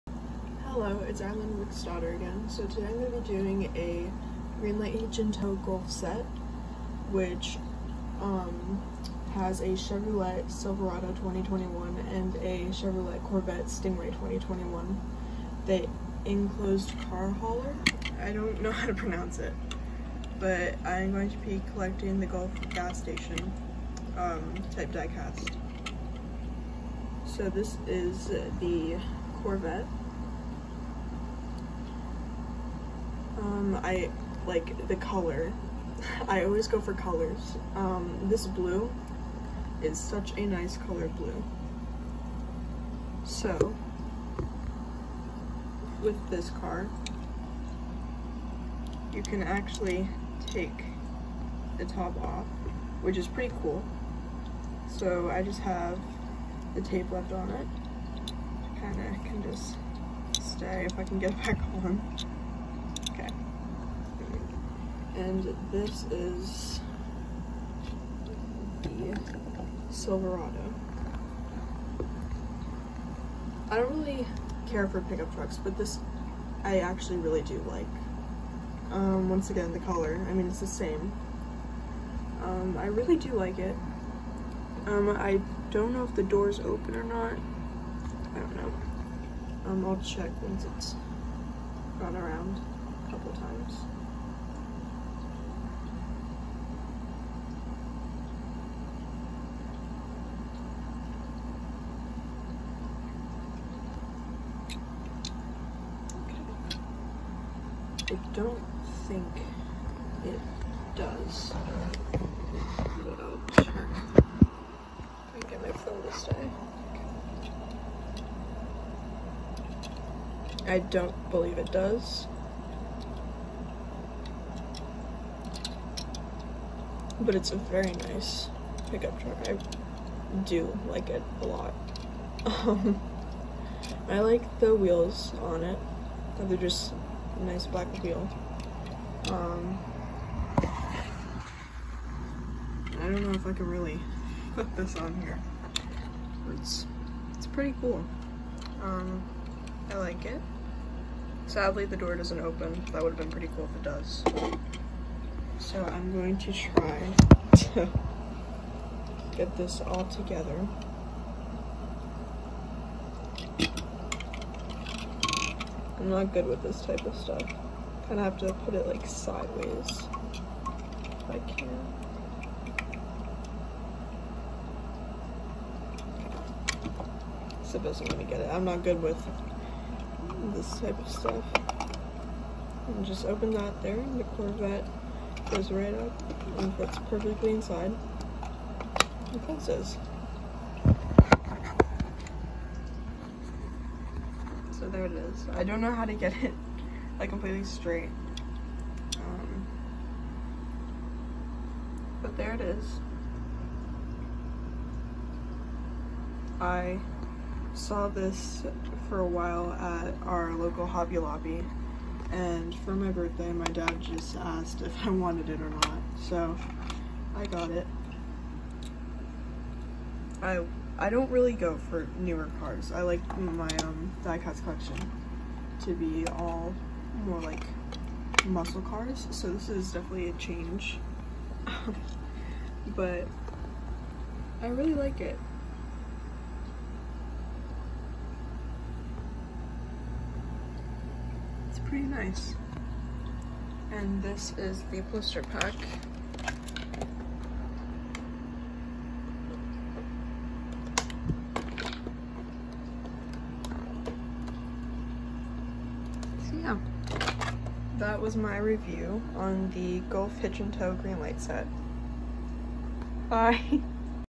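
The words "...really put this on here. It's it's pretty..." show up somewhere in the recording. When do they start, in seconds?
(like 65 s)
143 s.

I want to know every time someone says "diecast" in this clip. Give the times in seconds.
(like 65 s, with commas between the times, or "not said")
24 s, 224 s.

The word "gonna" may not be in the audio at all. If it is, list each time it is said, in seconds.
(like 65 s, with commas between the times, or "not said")
178 s.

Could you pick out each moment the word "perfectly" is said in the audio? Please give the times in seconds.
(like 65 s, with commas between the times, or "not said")
187 s.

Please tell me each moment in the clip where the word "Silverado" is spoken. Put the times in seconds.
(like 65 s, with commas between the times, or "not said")
10 s, 69 s.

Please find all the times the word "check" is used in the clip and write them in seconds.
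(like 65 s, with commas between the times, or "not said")
90 s, 113 s.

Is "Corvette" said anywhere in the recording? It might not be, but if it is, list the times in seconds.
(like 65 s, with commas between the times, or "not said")
13 s, 29 s, 184 s.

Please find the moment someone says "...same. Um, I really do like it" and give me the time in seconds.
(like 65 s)
80 s.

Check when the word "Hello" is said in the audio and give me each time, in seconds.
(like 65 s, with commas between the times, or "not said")
0 s.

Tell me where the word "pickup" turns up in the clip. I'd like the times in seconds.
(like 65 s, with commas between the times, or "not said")
75 s, 128 s.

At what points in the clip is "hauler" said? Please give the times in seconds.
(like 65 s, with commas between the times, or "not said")
17 s.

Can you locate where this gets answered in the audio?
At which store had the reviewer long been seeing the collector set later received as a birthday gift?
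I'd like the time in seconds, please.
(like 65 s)
210 s.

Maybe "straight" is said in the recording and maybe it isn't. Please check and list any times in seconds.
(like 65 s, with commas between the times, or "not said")
197 s.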